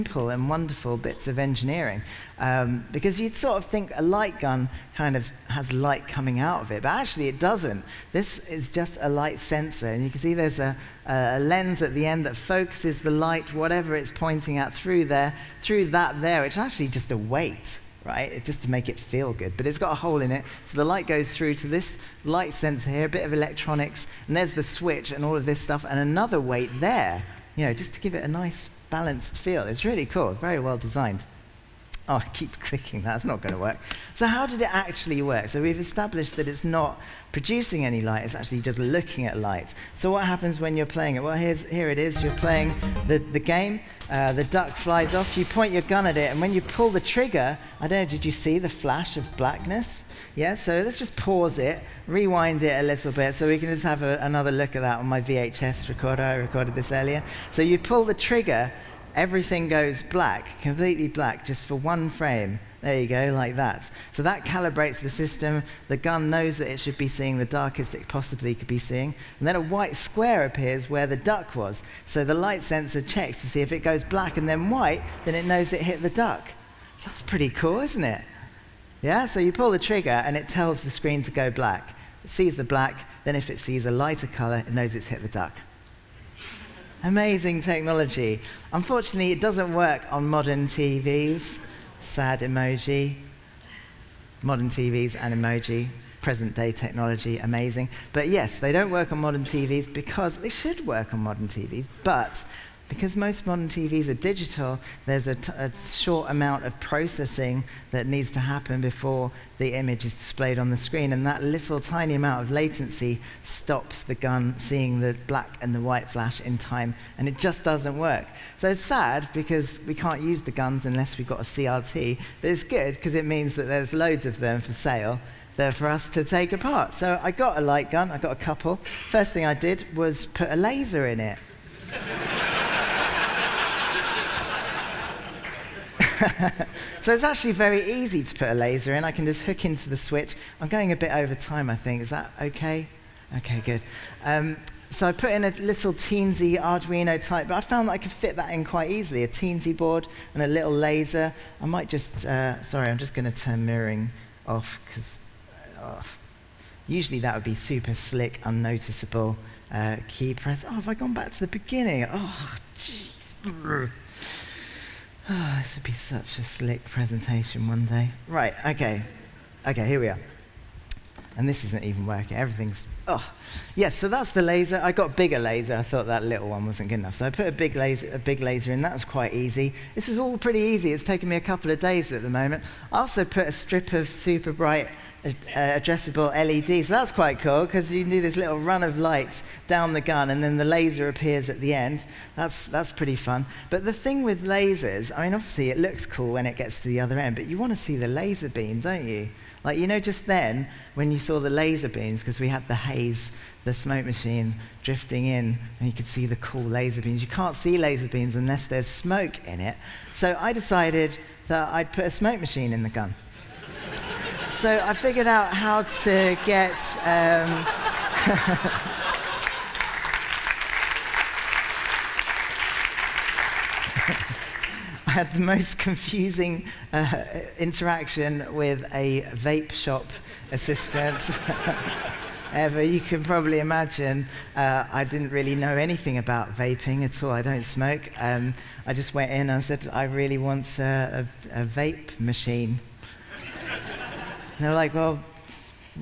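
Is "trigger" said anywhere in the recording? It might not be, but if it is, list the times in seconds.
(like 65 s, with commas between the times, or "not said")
46 s, 58 s, 79 s.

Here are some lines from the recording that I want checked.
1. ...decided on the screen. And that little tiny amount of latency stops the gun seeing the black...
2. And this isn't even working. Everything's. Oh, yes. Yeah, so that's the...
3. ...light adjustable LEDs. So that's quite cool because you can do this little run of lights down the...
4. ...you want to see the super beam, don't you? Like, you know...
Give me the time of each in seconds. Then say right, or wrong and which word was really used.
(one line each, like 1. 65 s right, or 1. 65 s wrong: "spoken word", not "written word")
1. 110 s wrong: "displayed", not "decided"
2. 171 s right
3. 184 s wrong: "bright", not "light"
4. 197 s wrong: "laser", not "super".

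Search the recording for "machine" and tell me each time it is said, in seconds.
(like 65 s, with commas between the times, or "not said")
204 s, 212 s, 242 s.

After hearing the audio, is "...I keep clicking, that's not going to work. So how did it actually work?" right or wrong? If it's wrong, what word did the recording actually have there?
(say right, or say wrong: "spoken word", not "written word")
right.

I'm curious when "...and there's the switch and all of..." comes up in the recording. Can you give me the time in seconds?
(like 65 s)
24 s.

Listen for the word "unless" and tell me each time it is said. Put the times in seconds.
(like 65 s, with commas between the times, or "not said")
120 s, 208 s.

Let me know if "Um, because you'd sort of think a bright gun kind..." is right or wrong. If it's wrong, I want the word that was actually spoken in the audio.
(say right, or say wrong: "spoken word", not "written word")
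wrong: "light", not "bright".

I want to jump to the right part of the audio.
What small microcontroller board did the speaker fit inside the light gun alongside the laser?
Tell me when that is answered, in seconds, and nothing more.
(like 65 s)
149 s.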